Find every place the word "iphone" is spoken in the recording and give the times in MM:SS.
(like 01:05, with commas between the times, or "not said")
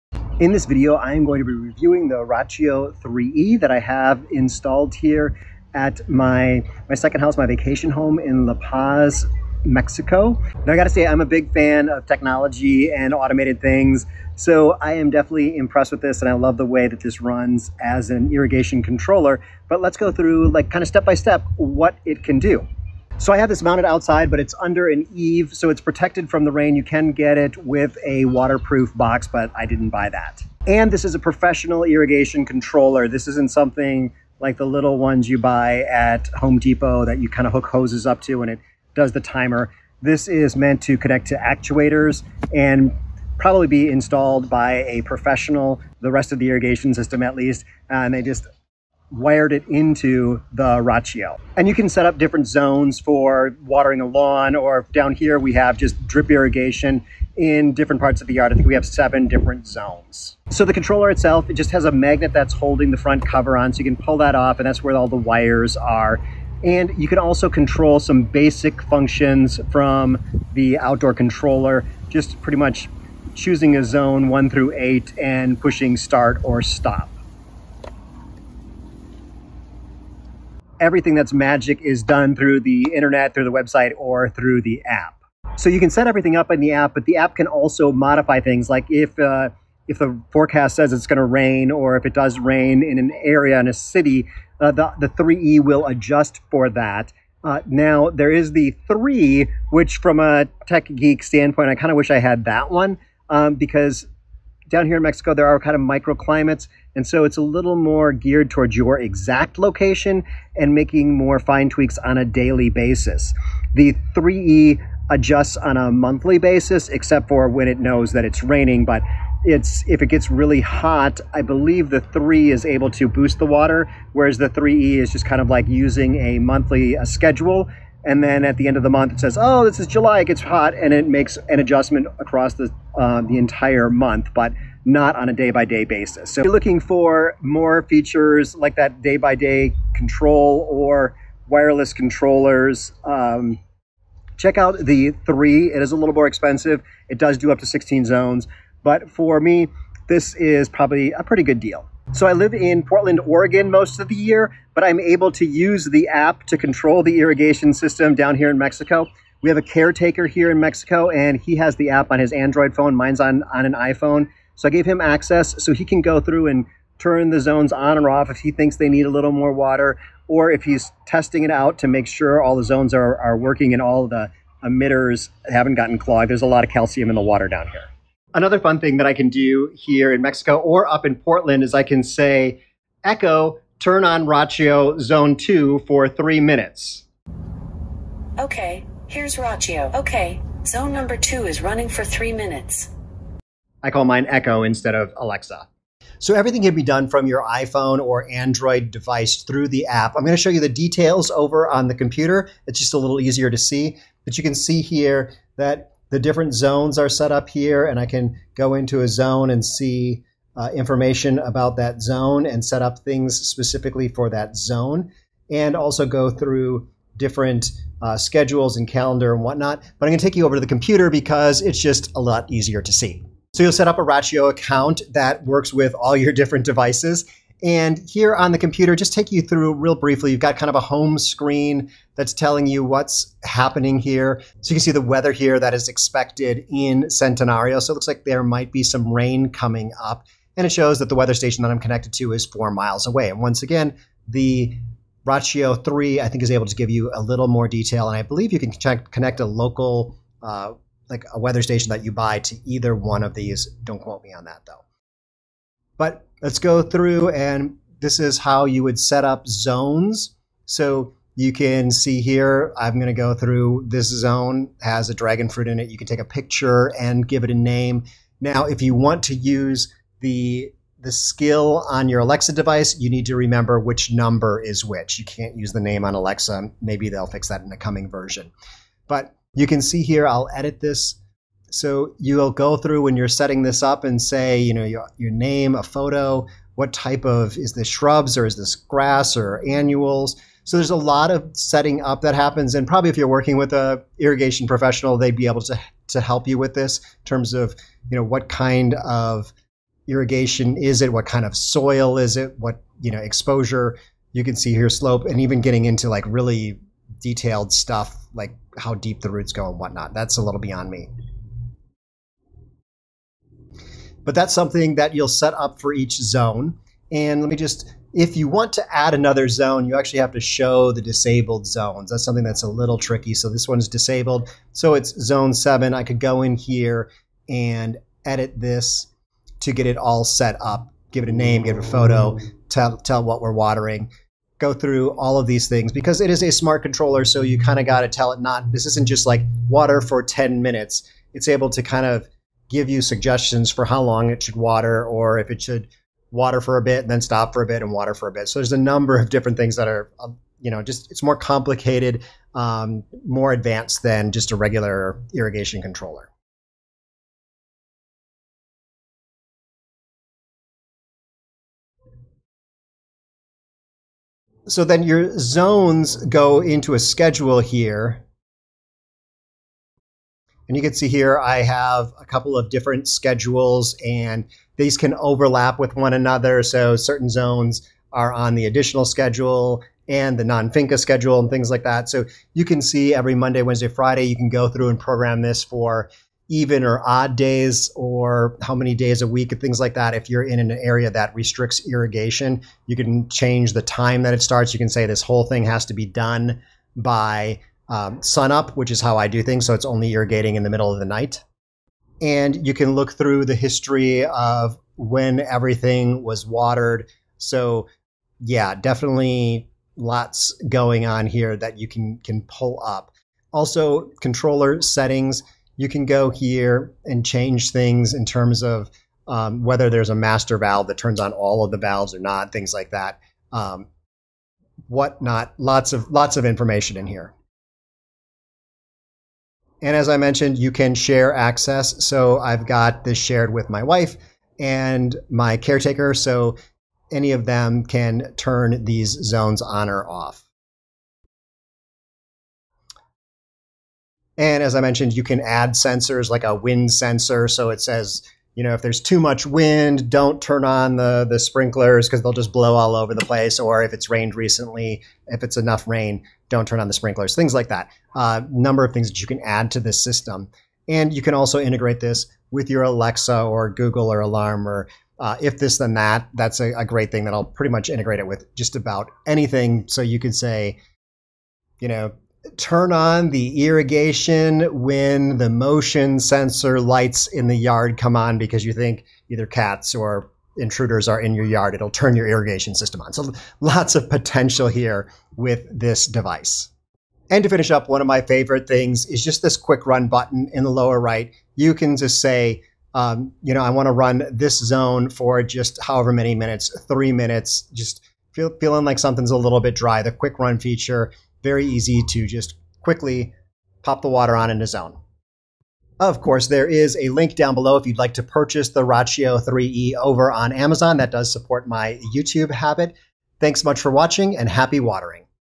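02:43, 03:17.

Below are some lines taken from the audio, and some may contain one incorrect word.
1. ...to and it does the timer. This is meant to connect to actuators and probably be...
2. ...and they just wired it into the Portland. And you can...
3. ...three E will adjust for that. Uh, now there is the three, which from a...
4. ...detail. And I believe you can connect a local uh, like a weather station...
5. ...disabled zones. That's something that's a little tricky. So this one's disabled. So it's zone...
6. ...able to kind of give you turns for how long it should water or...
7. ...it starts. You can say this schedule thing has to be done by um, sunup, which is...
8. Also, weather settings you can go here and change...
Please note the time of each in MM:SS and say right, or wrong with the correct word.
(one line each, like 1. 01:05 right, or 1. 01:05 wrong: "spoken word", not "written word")
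1. 00:38 right
2. 00:47 wrong: "Rachio", not "Portland"
3. 01:35 right
4. 04:07 right
5. 05:21 right
6. 05:41 wrong: "suggestions", not "turns"
7. 06:34 wrong: "whole", not "schedule"
8. 06:53 wrong: "controller", not "weather".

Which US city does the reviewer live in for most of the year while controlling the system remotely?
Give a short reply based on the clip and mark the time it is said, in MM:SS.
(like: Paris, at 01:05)
Portland, Oregon, at 02:32.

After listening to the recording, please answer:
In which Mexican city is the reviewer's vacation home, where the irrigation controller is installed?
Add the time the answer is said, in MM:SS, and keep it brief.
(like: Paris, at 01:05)
La Paz, at 00:08.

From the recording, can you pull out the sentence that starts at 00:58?
I think we have seven different zones.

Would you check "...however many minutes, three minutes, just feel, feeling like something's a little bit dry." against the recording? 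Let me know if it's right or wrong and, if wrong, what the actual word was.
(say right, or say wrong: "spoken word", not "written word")
right.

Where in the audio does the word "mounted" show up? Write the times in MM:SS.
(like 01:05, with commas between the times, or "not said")
00:23.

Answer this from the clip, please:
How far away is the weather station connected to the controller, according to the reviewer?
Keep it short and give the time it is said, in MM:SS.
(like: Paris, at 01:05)
4 miles, at 04:02.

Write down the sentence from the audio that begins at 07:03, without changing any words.
Um, whatnot, lots of lots of information in here.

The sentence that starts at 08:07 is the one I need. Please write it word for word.
And to finish up, one of my favorite things is just this quick run button in the lower right.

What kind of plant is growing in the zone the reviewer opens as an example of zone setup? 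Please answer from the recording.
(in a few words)
dragon fruit.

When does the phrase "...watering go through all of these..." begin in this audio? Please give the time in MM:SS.
05:33.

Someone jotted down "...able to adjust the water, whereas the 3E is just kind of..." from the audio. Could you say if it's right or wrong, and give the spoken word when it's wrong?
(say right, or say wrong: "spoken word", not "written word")
wrong: "boost", not "adjust".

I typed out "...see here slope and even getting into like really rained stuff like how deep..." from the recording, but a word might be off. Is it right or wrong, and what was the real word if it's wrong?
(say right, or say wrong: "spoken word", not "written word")
wrong: "detailed", not "rained".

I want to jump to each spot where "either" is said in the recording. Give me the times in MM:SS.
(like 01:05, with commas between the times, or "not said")
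04:12, 07:59.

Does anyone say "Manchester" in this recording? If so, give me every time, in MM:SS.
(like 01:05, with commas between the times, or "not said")
not said.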